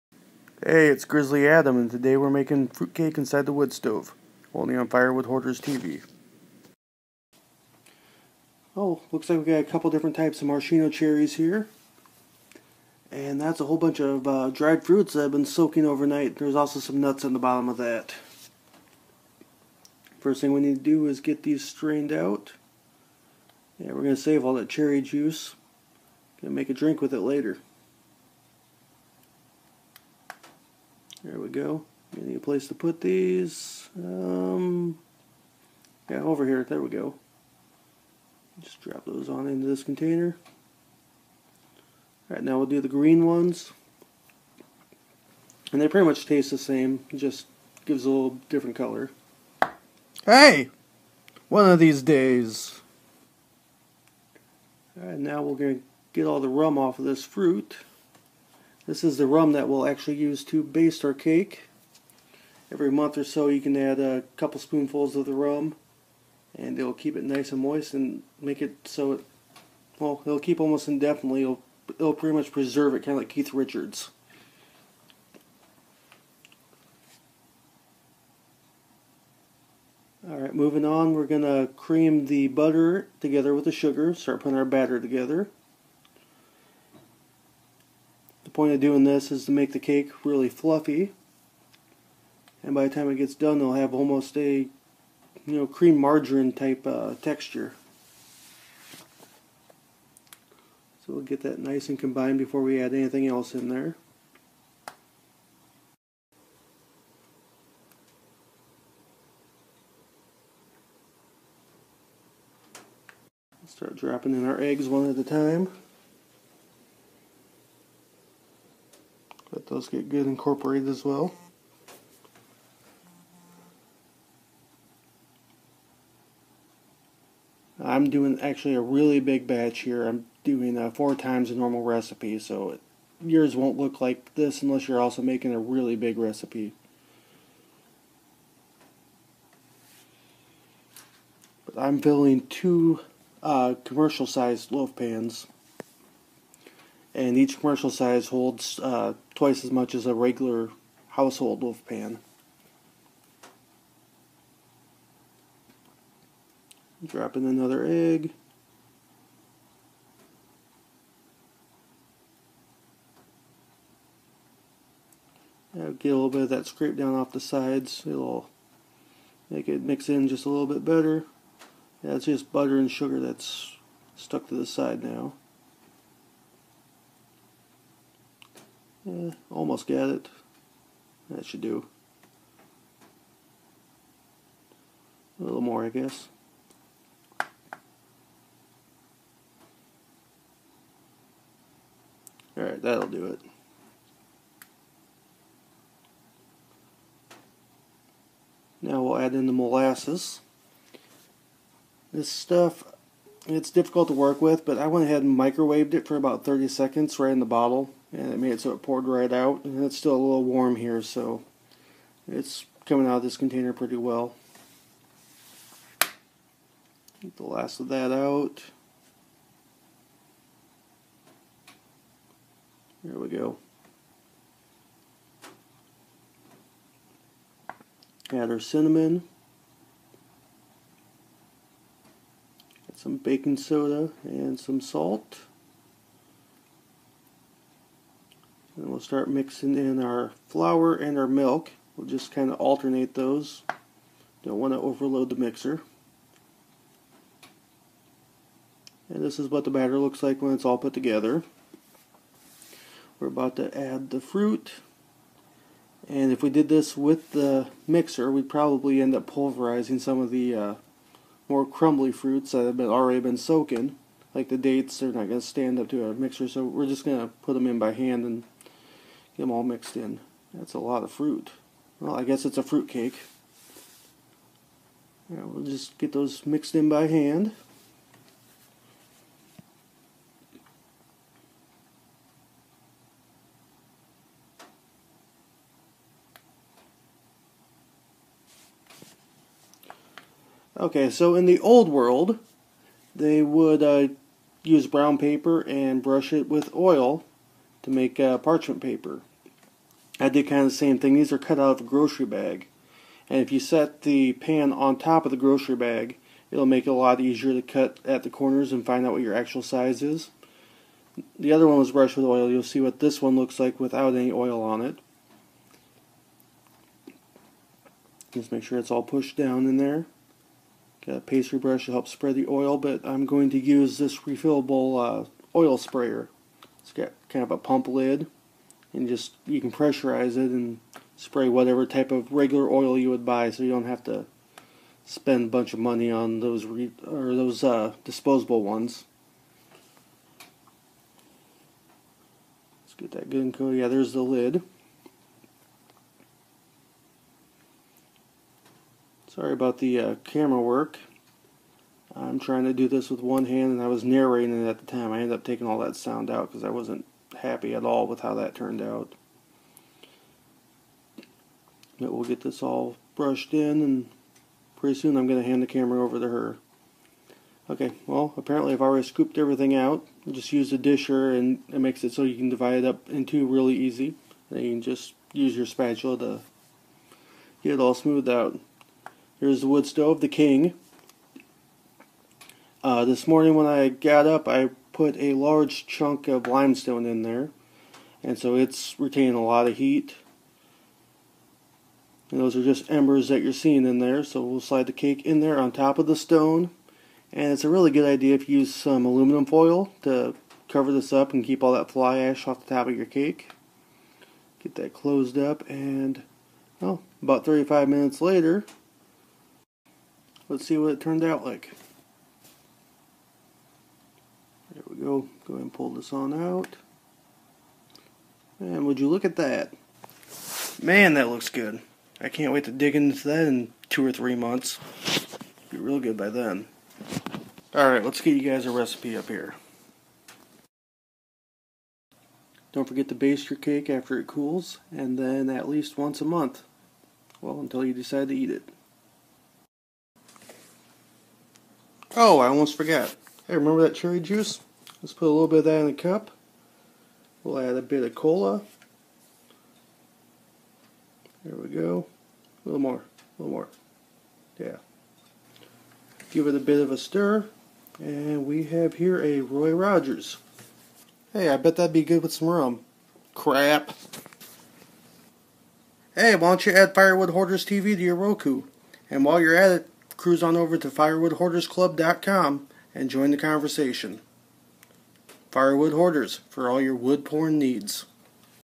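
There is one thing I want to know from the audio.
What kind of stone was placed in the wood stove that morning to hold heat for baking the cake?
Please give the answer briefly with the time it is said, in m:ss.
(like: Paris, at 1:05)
Limestone, at 6:26.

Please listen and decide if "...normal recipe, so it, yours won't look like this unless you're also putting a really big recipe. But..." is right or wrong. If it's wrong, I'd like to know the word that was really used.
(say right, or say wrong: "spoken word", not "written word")
wrong: "making", not "putting".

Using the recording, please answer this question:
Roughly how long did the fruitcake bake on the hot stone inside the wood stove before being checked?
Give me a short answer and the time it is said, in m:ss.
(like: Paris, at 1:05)
35 minutes, at 6:47.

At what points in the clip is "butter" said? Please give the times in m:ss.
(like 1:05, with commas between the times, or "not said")
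1:22, 2:52.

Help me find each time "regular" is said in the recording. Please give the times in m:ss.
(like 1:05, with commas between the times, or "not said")
2:30, 5:32.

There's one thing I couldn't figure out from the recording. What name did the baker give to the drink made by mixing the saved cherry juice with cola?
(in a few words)
Roy Rogers.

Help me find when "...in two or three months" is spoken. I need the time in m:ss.
7:03.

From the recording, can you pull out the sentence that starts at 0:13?
And that's a whole bunch of uh, dried fruits that have been soaking overnight.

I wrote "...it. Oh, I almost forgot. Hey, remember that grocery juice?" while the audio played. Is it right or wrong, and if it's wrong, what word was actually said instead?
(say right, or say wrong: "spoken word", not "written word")
wrong: "cherry", not "grocery".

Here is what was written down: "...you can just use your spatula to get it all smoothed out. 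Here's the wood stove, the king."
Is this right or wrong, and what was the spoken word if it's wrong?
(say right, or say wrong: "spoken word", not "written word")
right.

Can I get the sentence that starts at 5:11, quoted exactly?
The other one was brushed with oil.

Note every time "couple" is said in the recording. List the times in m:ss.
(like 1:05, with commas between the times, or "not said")
0:09, 1:04.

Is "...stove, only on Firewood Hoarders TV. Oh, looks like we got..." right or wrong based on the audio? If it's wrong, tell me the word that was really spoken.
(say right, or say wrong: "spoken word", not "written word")
right.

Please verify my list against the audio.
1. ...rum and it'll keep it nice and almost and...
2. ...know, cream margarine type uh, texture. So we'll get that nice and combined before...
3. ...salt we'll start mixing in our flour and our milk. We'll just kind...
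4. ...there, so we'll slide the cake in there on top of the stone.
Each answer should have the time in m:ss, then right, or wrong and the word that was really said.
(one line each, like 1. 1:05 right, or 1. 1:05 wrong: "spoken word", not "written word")
1. 1:05 wrong: "moist", not "almost"
2. 1:35 right
3. 3:54 right
4. 6:33 right.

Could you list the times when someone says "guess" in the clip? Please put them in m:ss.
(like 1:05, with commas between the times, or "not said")
3:05, 4:32.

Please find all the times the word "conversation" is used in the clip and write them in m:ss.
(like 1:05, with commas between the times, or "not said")
7:53.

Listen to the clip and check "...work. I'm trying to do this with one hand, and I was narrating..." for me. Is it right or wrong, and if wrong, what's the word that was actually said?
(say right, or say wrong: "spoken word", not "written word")
right.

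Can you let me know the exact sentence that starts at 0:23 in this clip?
Yeah, we're going to save all that cherry juice.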